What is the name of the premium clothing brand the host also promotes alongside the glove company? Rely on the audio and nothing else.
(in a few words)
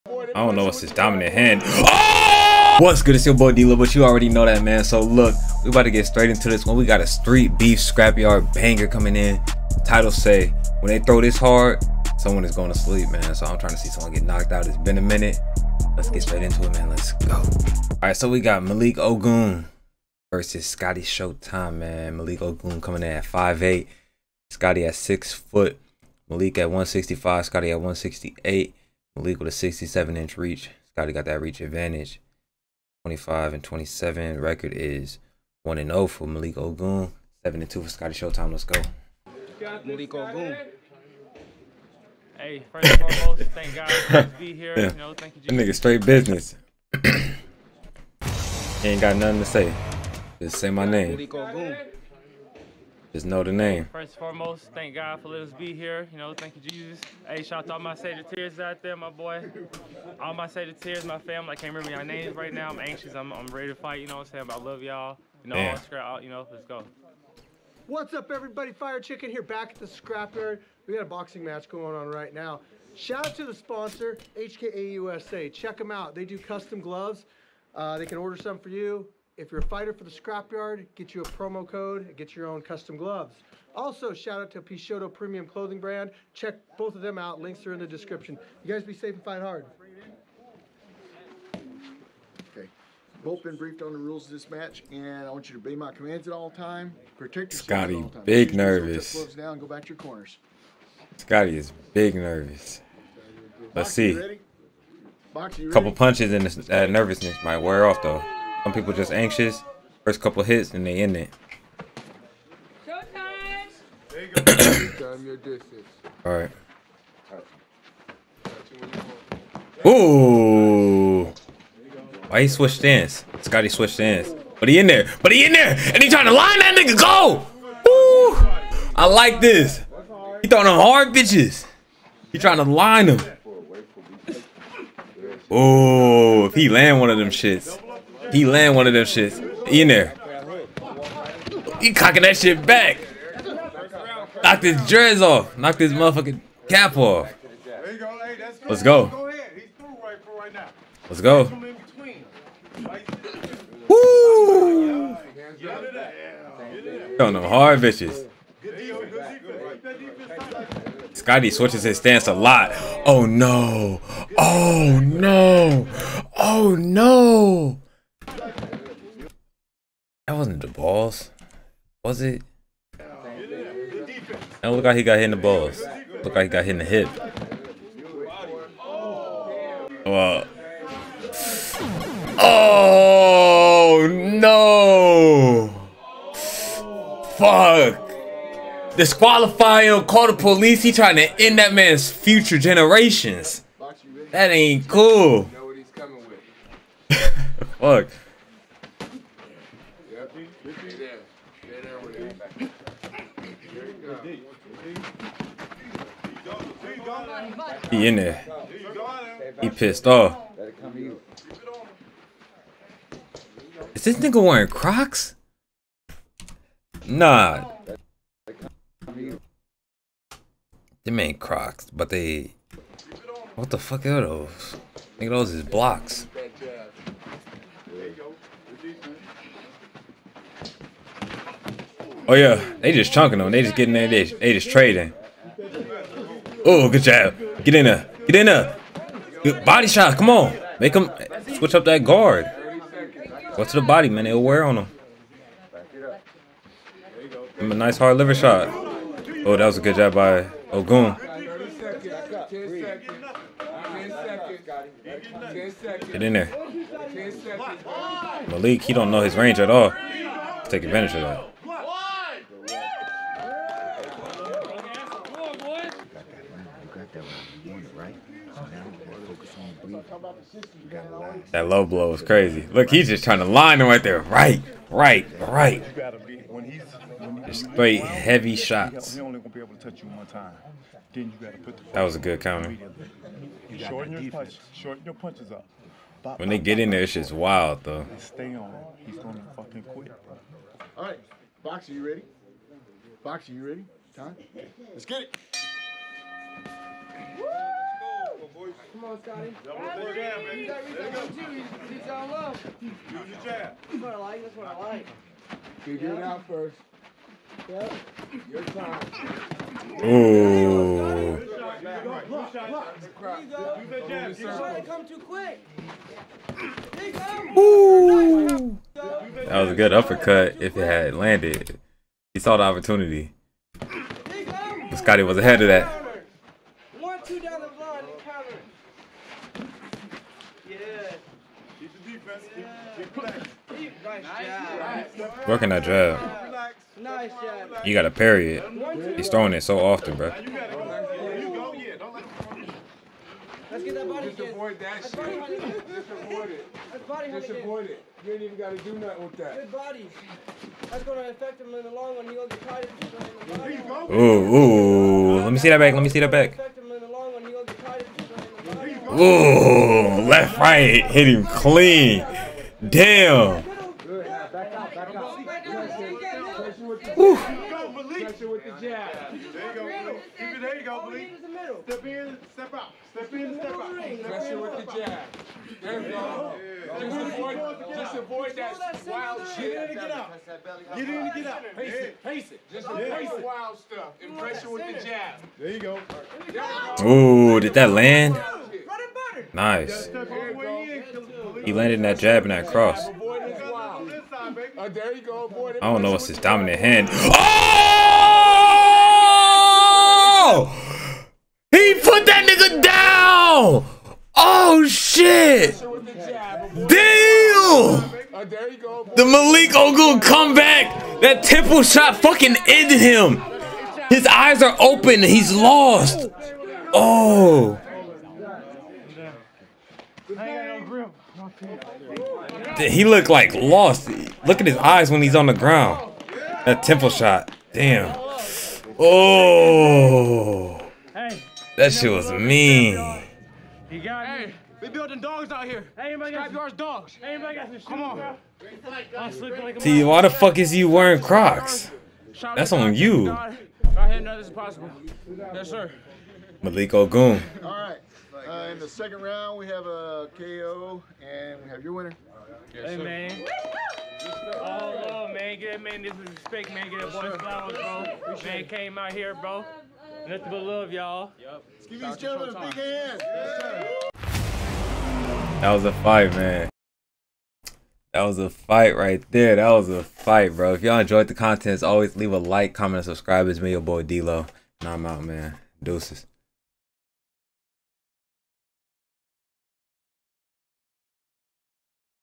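Pichoto.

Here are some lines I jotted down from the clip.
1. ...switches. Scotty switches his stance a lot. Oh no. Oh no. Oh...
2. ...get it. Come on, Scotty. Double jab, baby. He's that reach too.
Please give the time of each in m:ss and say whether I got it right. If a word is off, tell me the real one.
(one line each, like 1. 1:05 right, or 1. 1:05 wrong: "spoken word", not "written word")
1. 2:37 wrong: "bitches", not "switches"
2. 4:55 right.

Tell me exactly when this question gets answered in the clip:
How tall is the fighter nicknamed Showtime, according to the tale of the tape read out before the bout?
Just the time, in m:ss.
0:24.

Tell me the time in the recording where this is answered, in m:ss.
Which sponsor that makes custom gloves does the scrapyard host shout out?
1:14.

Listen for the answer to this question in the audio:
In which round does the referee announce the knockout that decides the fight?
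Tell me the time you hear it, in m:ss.
7:28.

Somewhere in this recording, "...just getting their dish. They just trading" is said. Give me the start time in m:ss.
3:53.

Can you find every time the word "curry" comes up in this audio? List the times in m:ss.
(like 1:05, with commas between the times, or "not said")
not said.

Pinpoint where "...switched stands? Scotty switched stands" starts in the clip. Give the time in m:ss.
2:02.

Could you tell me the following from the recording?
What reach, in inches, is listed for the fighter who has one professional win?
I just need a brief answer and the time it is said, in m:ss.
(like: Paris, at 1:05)
67 inches, at 0:29.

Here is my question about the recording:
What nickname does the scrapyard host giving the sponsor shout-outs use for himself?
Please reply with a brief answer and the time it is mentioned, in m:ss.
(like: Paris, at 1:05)
Fire Chicken, at 1:08.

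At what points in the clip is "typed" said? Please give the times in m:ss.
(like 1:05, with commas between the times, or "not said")
not said.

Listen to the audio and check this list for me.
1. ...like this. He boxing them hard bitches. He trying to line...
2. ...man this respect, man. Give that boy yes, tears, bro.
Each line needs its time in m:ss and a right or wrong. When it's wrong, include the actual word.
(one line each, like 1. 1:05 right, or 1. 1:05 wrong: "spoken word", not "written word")
1. 2:09 wrong: "throwing", not "boxing"
2. 7:35 wrong: "flowers", not "tears".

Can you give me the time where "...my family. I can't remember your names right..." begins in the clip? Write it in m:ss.
1:01.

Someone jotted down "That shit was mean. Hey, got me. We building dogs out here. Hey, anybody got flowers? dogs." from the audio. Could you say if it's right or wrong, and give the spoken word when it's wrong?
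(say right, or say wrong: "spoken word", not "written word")
wrong: "yours", not "flowers".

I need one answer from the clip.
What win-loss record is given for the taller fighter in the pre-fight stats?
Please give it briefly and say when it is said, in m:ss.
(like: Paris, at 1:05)
7 and 2, at 0:37.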